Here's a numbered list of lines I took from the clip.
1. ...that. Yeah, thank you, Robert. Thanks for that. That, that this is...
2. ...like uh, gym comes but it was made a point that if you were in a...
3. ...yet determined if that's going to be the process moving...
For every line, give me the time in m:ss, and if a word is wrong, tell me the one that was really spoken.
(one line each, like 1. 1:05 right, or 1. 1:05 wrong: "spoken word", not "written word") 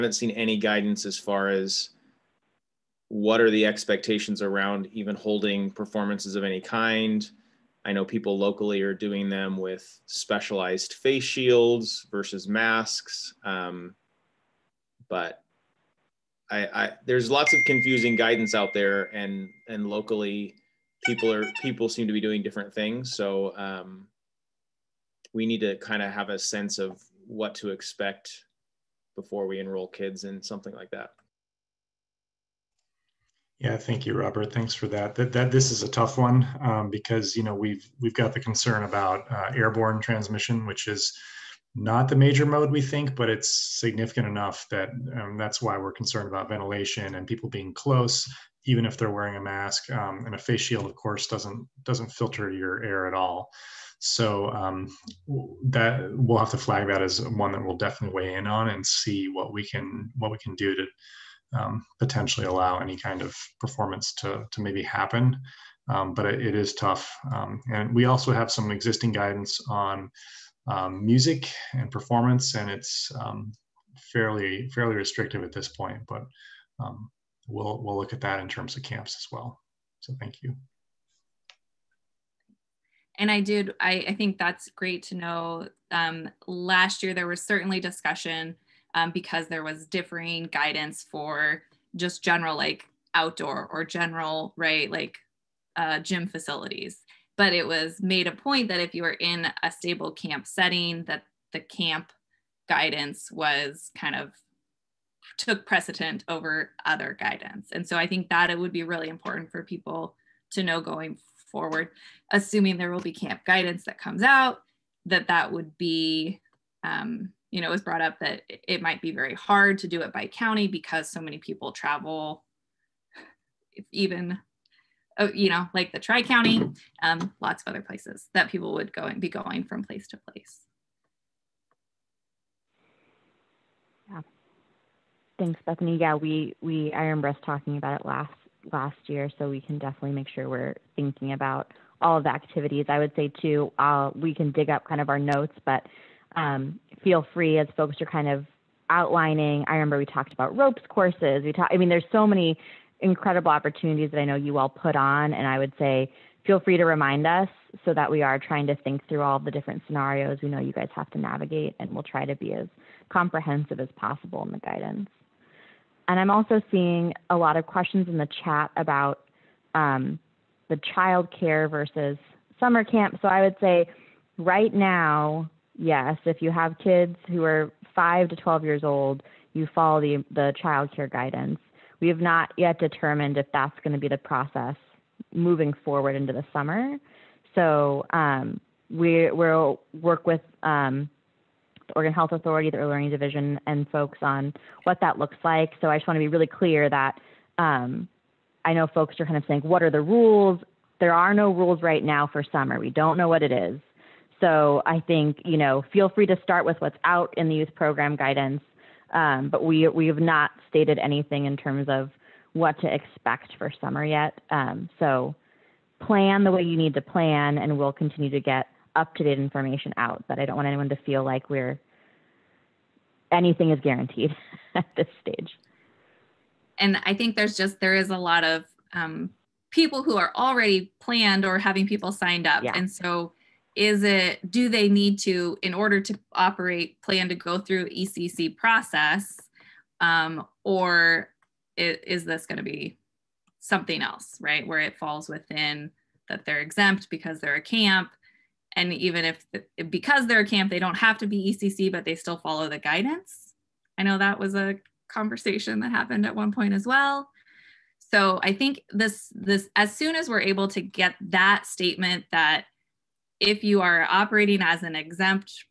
1. 0:30 right
2. 1:34 wrong: "facilities", not "comes"
3. 3:02 right.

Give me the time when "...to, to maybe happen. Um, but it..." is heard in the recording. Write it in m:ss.
1:04.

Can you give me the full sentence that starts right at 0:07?
I know people locally are doing them with specialized face shields versus masks.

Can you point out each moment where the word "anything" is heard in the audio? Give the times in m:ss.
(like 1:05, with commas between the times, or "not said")
3:30, 3:43.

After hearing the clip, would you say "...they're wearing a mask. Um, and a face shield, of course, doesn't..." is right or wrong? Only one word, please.
right.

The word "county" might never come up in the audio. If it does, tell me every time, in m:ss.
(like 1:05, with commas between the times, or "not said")
2:00, 2:06.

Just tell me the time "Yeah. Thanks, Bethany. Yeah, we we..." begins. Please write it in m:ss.
2:14.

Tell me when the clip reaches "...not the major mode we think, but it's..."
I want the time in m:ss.
0:41.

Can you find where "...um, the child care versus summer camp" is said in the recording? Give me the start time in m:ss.
2:49.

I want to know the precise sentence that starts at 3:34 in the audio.
Um, so plan the way you need to plan, and we'll continue to get up to date information out.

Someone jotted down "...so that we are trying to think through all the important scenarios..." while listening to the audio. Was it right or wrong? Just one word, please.
wrong.